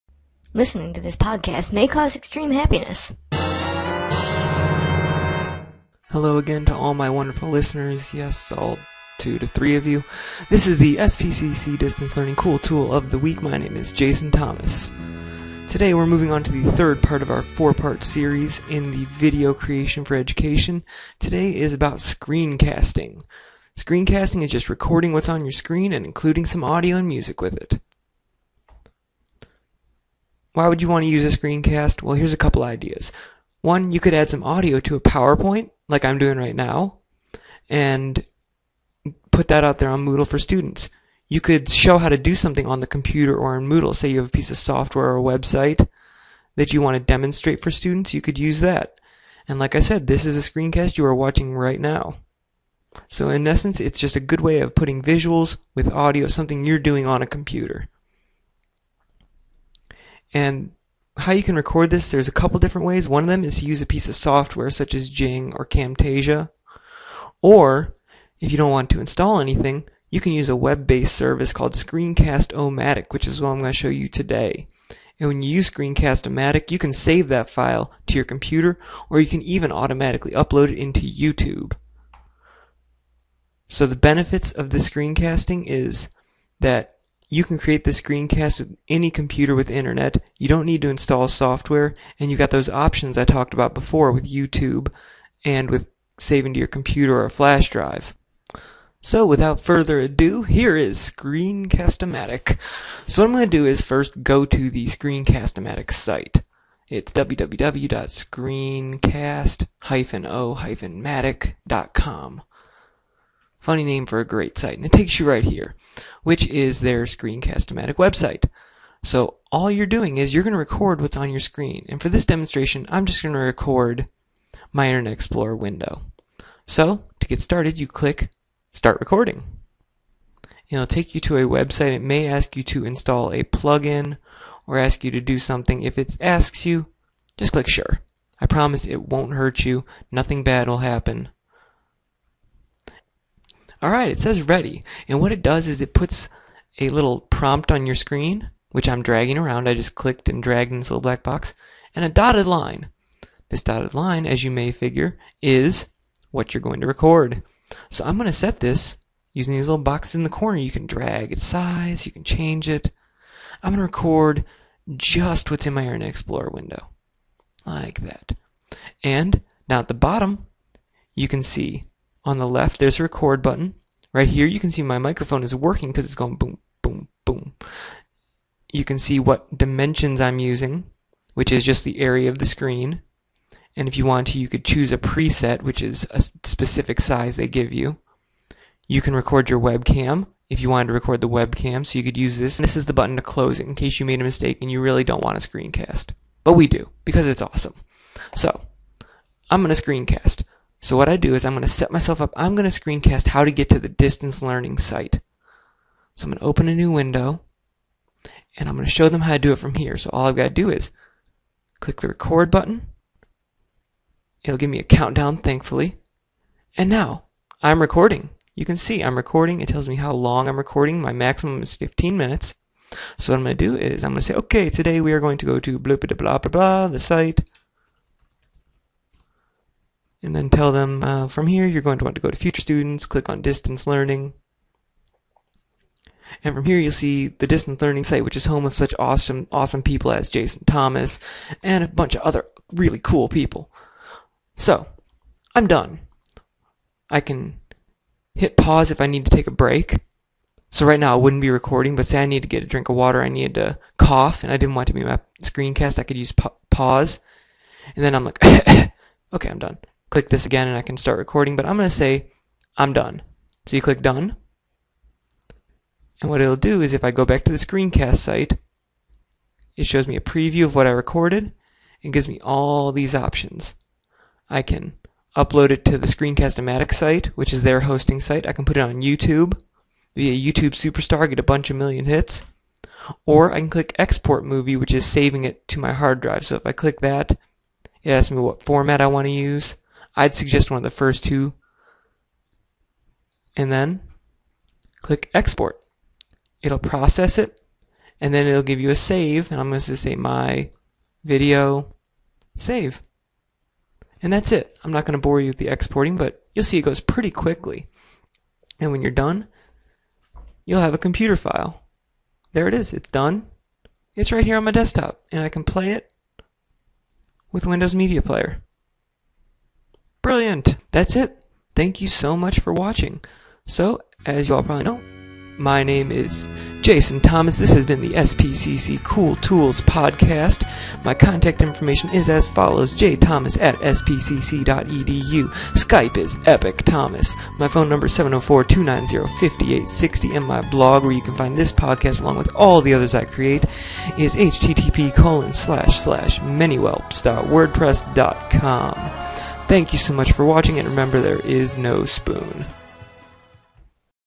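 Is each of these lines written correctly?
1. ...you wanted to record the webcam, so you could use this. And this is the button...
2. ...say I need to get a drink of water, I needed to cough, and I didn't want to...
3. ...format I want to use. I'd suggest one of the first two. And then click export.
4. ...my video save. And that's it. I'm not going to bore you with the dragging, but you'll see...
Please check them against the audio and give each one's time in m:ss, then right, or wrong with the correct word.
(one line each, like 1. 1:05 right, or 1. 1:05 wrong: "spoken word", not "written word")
1. 3:10 right
2. 4:12 right
3. 4:48 right
4. 5:00 wrong: "exporting", not "dragging".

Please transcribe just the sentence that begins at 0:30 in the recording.
Why would you want to use a screencast?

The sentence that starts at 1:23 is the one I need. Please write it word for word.
So the benefits of the screencasting is that you can create the screencast with any computer with internet.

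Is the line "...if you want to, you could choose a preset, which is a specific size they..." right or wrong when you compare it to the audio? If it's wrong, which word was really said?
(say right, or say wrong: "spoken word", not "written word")
right.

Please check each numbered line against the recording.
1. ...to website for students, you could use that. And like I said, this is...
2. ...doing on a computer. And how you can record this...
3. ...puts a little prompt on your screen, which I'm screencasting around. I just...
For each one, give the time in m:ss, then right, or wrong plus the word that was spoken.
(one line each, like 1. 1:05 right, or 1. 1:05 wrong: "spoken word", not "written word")
1. 0:46 wrong: "demonstrate", not "website"
2. 0:56 right
3. 2:25 wrong: "dragging", not "screencasting".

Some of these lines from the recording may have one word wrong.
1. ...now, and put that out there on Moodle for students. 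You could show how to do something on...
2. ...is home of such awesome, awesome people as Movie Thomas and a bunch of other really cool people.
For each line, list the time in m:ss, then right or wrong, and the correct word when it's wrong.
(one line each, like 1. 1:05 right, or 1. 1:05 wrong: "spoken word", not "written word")
1. 0:36 right
2. 3:58 wrong: "Jason", not "Movie".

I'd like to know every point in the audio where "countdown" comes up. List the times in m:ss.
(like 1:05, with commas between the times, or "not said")
3:34.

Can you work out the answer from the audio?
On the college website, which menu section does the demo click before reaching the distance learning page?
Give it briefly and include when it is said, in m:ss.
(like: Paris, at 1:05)
future students, at 3:52.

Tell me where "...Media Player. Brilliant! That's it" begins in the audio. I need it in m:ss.
5:17.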